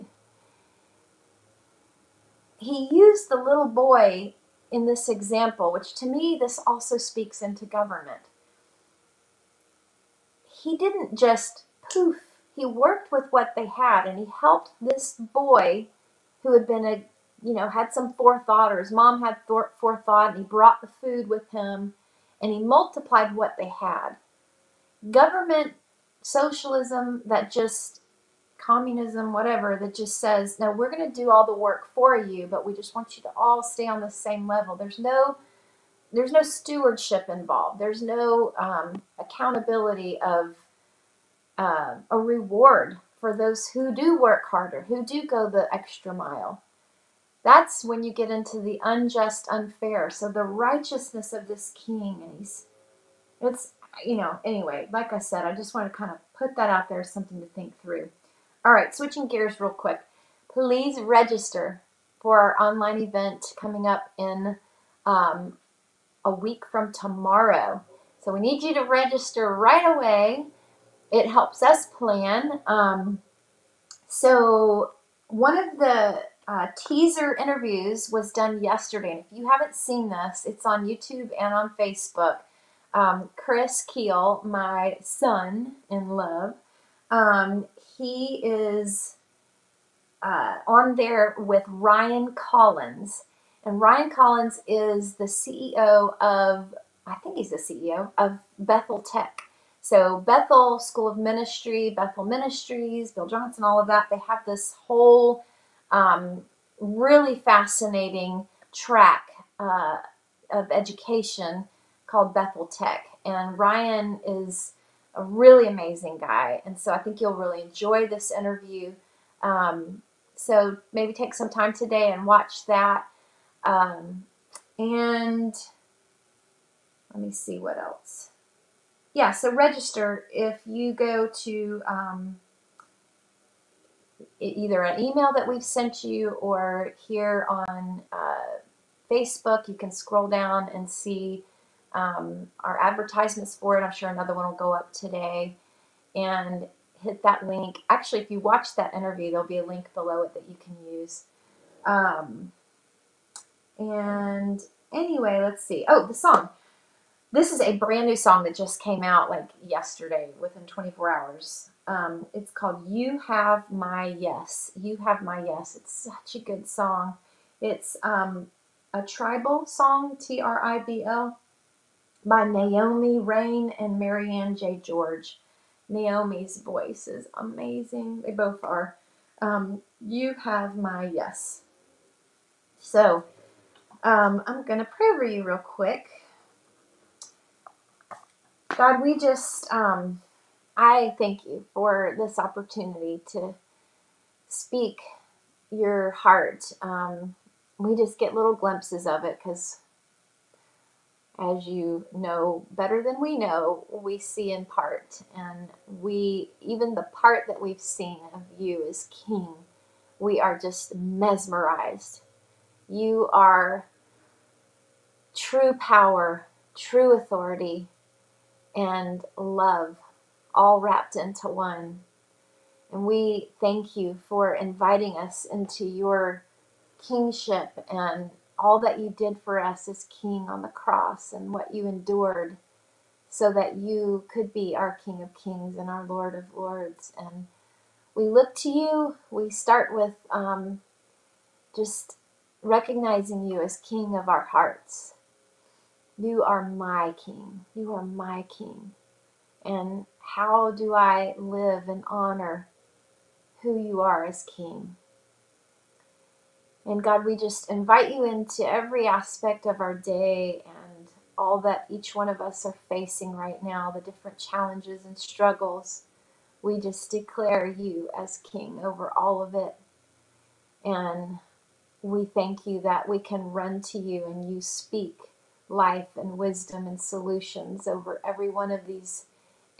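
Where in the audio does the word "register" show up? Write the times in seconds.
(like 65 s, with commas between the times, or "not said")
61 s, 68 s, 129 s.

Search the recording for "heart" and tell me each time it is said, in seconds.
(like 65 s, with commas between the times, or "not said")
196 s, 244 s.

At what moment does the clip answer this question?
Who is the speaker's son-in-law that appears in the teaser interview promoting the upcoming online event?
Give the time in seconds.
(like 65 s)
83 s.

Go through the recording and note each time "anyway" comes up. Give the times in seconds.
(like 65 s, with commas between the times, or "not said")
54 s, 154 s.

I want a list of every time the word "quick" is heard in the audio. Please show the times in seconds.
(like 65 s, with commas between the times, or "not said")
59 s, 185 s.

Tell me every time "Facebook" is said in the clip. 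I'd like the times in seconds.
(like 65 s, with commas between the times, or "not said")
81 s, 139 s.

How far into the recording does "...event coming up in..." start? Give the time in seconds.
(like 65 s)
63 s.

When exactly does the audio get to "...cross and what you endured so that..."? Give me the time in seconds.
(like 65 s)
230 s.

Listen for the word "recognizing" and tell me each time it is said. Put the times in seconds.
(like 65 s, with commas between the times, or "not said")
242 s.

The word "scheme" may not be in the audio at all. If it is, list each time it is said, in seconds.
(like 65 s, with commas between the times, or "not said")
not said.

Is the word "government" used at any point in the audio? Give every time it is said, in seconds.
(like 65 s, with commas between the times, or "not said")
7 s, 25 s.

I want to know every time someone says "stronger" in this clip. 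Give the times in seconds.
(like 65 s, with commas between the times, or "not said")
not said.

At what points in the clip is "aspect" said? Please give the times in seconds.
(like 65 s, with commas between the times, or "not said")
259 s.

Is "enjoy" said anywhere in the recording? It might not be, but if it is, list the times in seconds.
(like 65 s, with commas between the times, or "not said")
117 s.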